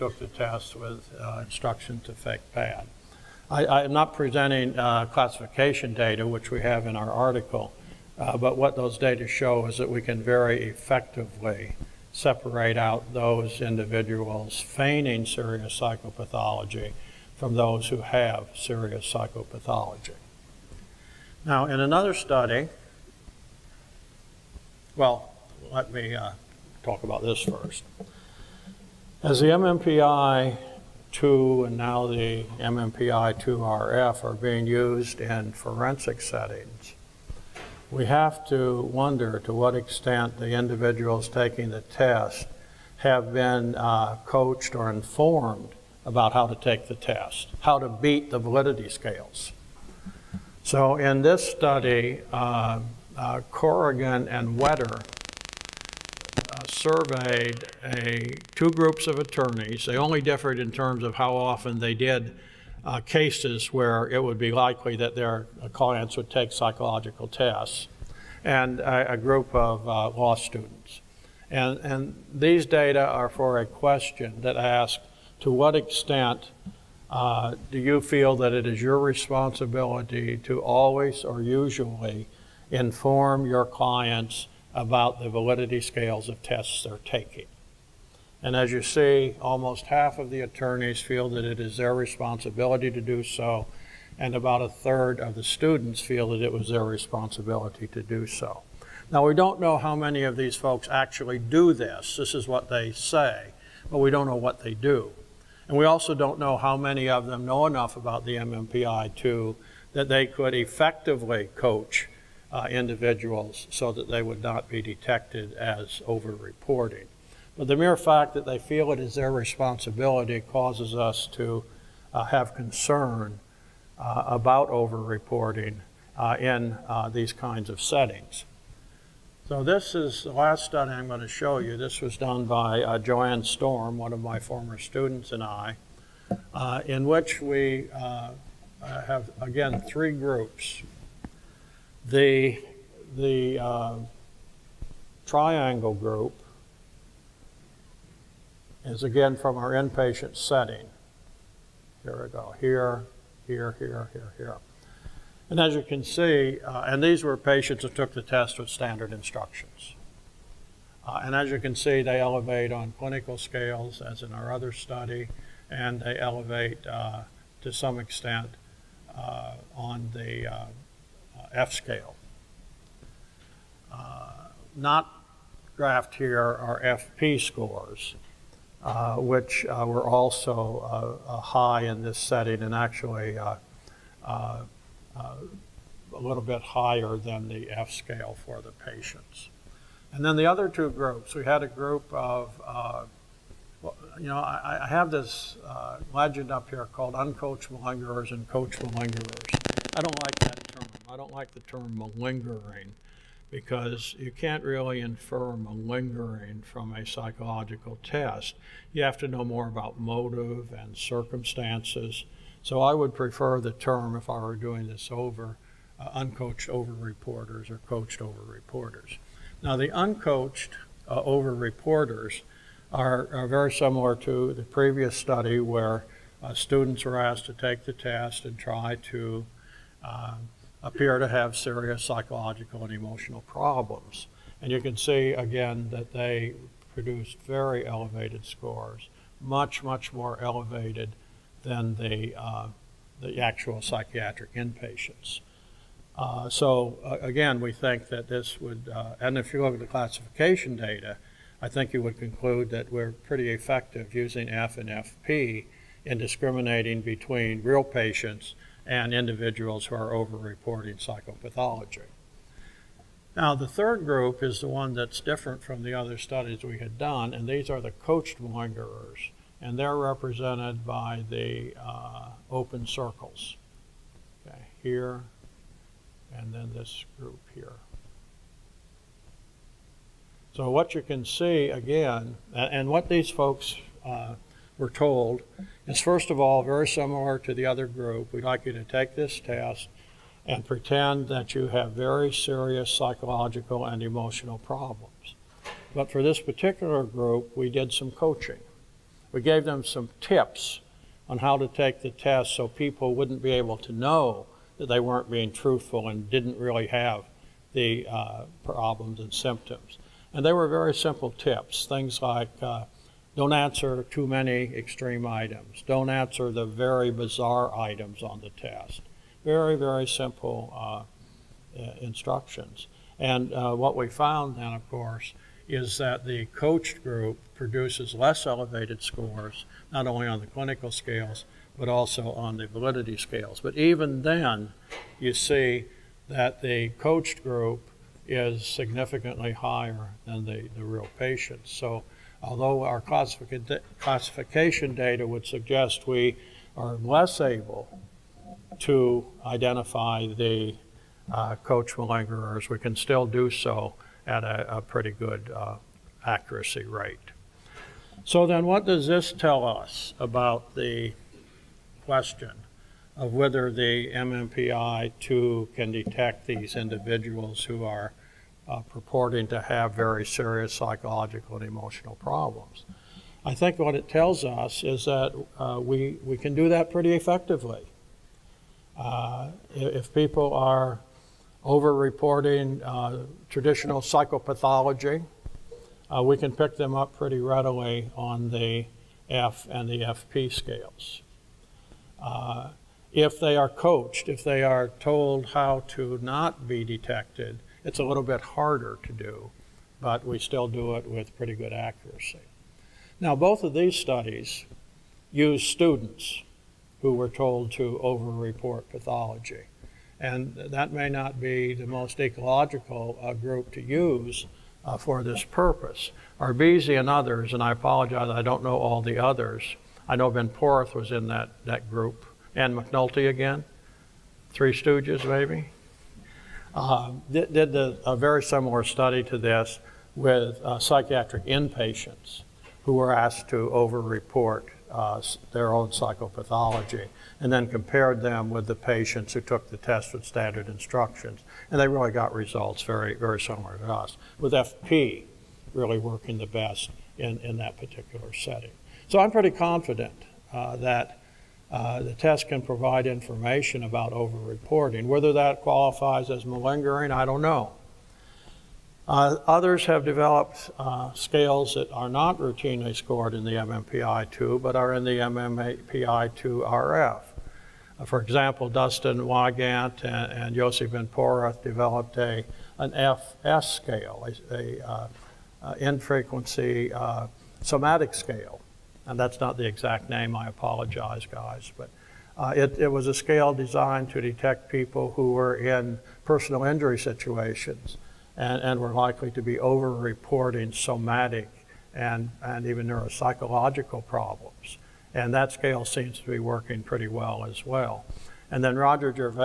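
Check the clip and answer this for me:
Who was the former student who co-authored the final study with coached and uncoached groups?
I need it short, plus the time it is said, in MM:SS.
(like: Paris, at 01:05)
Joanne Storm, at 02:12.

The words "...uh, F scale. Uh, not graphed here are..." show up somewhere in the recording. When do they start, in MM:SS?
02:50.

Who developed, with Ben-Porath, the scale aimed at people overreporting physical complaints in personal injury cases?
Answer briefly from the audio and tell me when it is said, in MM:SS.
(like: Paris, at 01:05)
Dustin Wygant, at 07:48.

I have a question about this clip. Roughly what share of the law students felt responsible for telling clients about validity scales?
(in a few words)
about a third.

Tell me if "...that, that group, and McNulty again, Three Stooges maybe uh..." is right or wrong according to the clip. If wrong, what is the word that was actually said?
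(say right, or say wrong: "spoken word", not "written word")
right.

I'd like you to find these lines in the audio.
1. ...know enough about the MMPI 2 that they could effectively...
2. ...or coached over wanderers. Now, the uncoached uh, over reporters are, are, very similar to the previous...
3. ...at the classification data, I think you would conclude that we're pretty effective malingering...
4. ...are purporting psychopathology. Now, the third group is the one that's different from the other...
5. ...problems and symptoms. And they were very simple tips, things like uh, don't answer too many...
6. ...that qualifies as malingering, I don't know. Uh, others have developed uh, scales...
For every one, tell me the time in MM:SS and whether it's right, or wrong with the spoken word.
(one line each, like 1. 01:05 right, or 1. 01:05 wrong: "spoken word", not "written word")
1. 01:47 right
2. 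03:37 wrong: "reporters", not "wanderers"
3. 04:09 wrong: "using", not "malingering"
4. 04:19 wrong: "overreporting", not "purporting"
5. 05:08 right
6. 07:35 right.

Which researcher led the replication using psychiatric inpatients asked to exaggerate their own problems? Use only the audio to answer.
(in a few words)
Arbisi.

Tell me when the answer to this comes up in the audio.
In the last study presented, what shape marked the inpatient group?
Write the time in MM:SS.
02:25.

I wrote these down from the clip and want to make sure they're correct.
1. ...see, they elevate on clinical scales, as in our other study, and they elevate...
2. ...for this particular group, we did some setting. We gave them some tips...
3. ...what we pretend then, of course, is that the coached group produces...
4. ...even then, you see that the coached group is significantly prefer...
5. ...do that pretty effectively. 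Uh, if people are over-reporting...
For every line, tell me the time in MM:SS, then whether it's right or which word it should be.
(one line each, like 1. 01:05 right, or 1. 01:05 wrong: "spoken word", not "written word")
1. 02:41 right
2. 04:56 wrong: "coaching", not "setting"
3. 05:23 wrong: "found", not "pretend"
4. 05:33 wrong: "higher", not "prefer"
5. 06:16 right.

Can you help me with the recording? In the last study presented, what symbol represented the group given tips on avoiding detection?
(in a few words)
open circles.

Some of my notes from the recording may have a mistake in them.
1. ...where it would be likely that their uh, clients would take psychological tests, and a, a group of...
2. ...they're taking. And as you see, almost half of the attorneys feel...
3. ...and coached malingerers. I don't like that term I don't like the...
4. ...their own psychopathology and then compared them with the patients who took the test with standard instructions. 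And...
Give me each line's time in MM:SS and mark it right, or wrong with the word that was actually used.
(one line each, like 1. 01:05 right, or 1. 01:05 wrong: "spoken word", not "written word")
1. 01:03 right
2. 01:26 right
3. 03:18 right
4. 07:15 right.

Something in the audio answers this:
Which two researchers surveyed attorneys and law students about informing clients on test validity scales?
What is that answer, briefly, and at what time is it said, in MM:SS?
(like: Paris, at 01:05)
Corrigan and Wetter, at 00:53.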